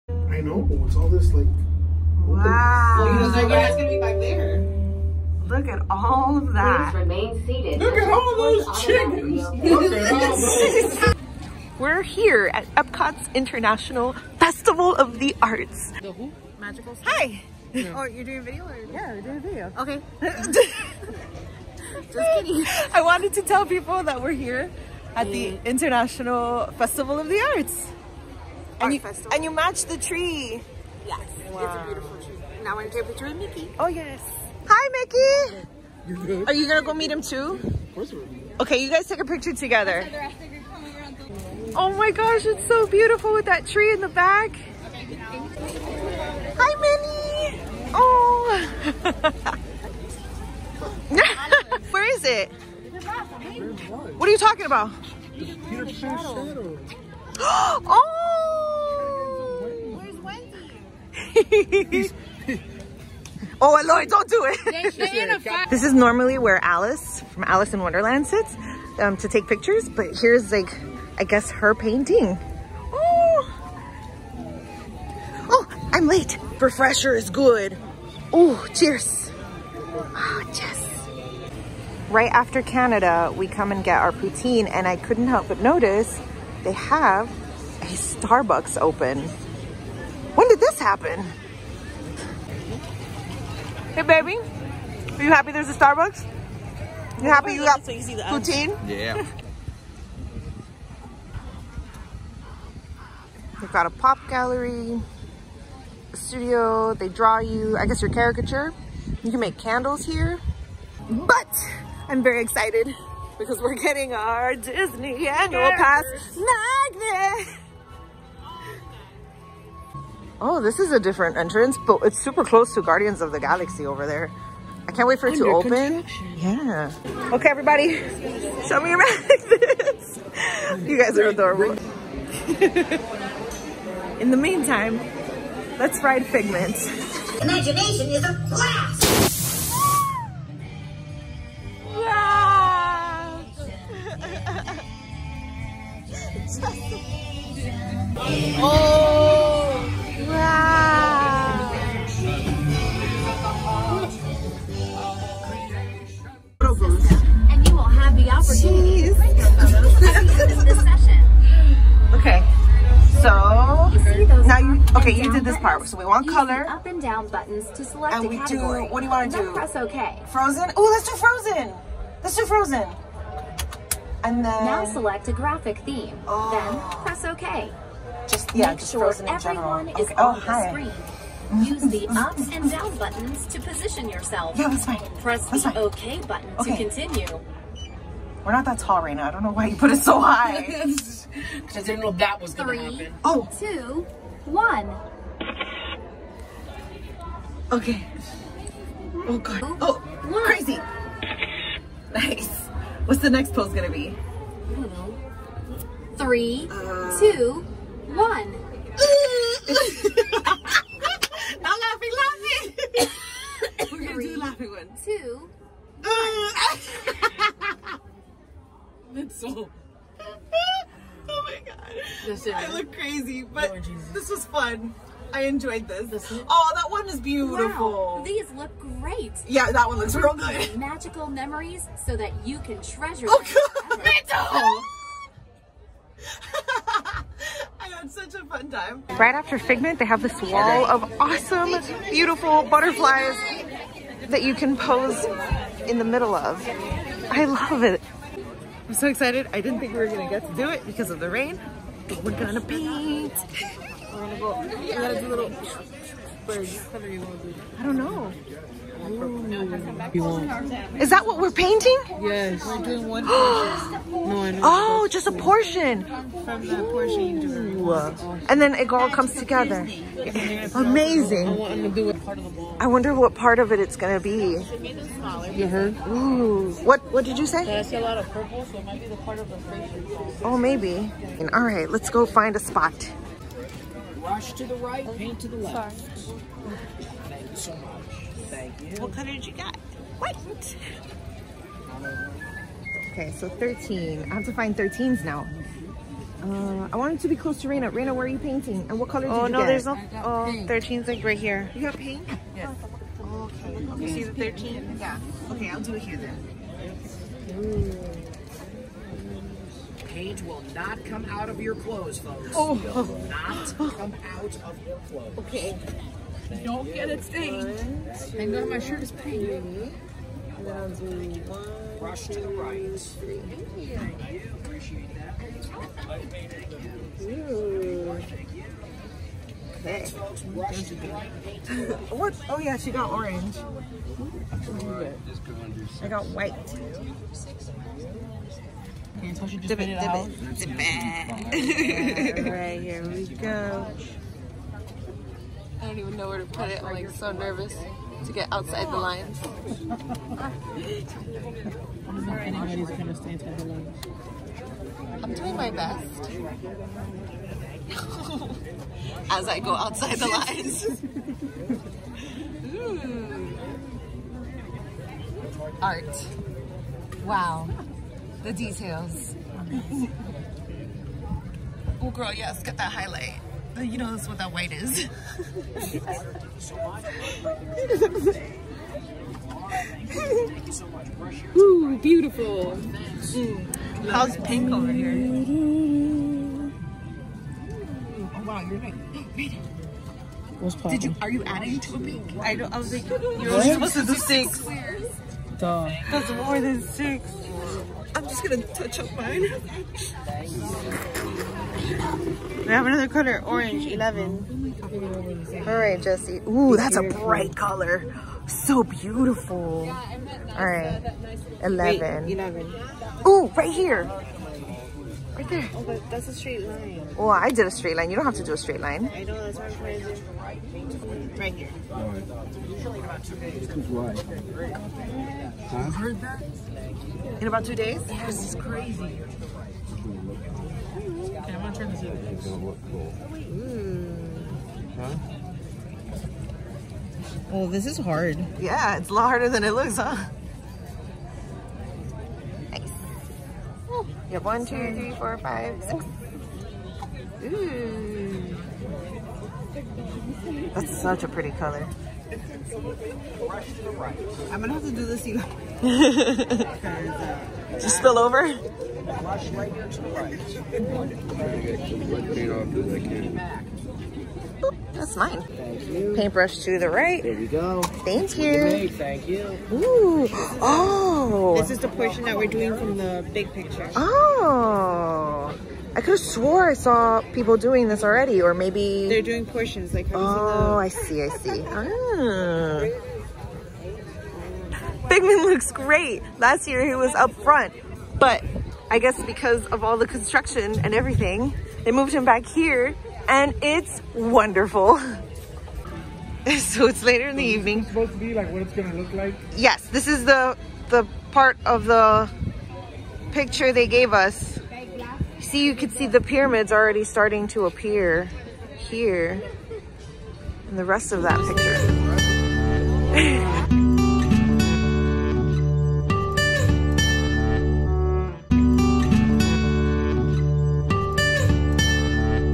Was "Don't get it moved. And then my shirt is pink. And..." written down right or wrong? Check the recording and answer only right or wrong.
wrong.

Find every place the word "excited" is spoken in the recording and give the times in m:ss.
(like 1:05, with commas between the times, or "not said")
1:52, 4:09.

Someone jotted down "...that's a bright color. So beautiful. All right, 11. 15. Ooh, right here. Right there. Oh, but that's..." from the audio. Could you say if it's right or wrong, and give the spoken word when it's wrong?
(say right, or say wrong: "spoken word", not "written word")
wrong: "11", not "15".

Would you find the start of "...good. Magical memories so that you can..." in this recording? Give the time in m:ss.
3:50.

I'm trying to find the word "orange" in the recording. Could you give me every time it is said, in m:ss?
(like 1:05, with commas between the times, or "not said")
5:33, 6:43.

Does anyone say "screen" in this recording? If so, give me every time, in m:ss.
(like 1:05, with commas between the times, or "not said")
3:00.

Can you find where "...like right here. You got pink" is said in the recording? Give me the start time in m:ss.
5:01.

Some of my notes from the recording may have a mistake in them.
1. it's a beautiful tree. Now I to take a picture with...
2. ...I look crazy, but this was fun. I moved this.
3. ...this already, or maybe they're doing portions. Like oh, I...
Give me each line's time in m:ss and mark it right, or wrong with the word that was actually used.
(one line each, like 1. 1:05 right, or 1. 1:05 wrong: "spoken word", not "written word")
1. 0:31 right
2. 3:42 wrong: "enjoyed", not "moved"
3. 7:57 right.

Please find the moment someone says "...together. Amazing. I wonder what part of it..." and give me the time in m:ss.
4:29.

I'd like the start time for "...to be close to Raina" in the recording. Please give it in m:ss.
4:57.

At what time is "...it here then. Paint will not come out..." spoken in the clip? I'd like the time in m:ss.
5:05.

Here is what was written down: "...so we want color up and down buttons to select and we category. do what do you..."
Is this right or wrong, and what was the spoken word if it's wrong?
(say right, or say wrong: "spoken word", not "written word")
right.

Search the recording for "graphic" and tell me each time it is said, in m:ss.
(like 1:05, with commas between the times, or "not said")
2:55.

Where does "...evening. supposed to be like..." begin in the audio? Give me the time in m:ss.
8:17.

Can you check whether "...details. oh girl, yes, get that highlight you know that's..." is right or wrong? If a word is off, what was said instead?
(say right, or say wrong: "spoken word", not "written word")
right.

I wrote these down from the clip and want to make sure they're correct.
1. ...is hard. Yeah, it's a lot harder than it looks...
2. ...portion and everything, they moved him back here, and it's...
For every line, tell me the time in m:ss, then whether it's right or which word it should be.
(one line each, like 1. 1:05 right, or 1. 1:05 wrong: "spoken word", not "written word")
1. 7:17 right
2. 8:10 wrong: "construction", not "portion".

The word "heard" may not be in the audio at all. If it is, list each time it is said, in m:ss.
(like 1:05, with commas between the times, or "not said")
4:35, 7:05.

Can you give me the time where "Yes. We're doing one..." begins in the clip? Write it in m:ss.
4:22.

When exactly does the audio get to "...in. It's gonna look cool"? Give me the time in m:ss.
7:12.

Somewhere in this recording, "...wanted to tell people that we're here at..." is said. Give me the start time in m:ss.
0:23.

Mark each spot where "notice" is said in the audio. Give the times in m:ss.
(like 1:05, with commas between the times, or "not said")
1:25.